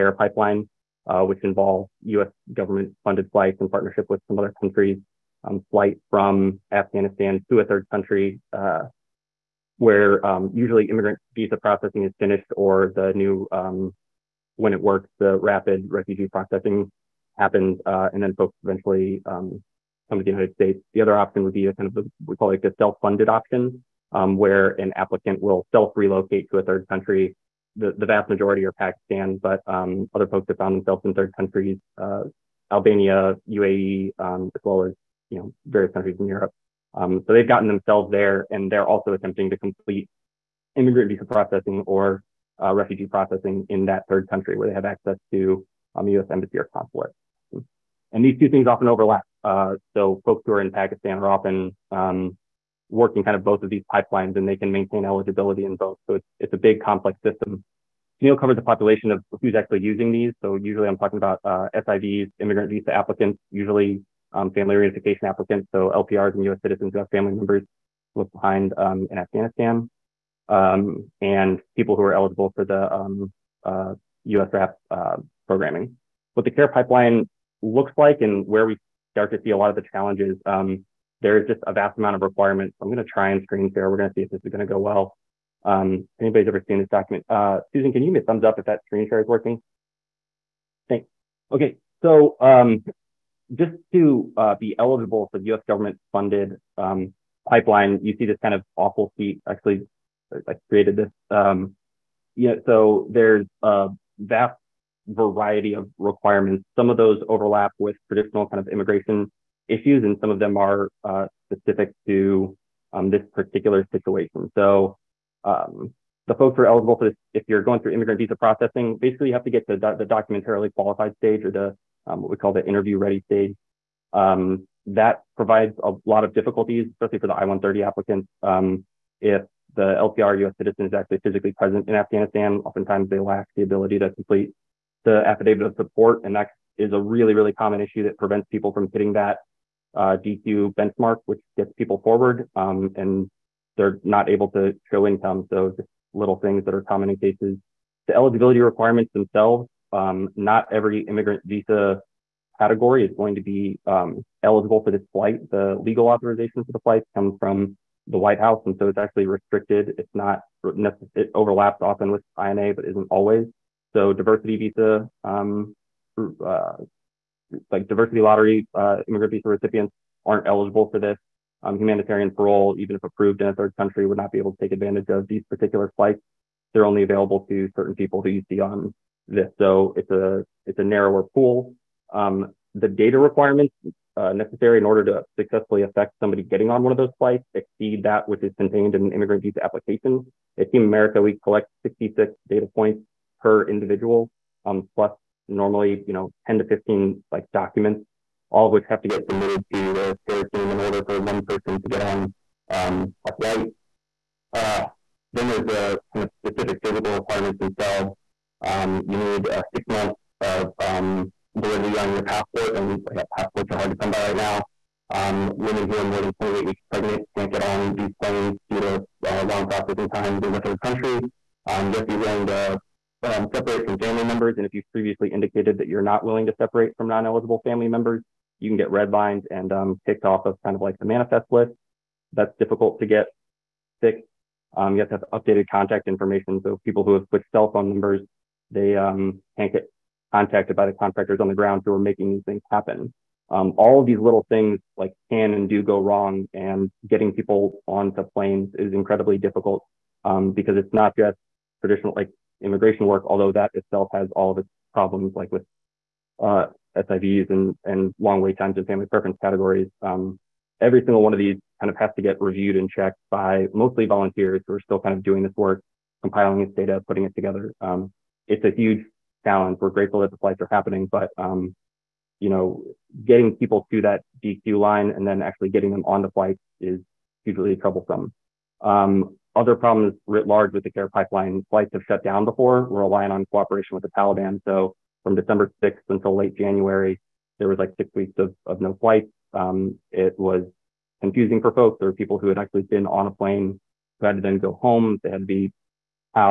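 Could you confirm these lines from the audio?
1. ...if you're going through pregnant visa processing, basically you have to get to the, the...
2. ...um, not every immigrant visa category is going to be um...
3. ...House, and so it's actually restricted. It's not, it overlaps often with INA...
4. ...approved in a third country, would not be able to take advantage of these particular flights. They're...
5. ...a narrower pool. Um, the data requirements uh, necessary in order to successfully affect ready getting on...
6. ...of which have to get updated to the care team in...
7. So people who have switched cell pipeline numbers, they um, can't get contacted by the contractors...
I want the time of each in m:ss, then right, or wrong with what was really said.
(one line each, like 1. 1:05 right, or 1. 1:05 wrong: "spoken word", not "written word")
1. 1:57 wrong: "immigrant", not "pregnant"
2. 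2:29 right
3. 2:38 right
4. 2:53 right
5. 3:00 wrong: "somebody", not "ready"
6. 3:18 wrong: "submitted", not "updated"
7. 3:56 wrong: "phone", not "pipeline".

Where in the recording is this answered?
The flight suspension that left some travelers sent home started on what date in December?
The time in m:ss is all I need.
4:45.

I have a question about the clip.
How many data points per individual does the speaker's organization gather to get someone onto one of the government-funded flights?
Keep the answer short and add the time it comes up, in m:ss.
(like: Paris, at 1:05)
66, at 3:11.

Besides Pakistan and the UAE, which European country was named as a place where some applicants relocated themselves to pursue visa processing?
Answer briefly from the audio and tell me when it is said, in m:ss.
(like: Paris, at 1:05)
Albania, at 0:32.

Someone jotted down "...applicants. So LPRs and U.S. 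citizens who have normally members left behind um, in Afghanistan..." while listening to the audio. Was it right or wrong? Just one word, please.
wrong.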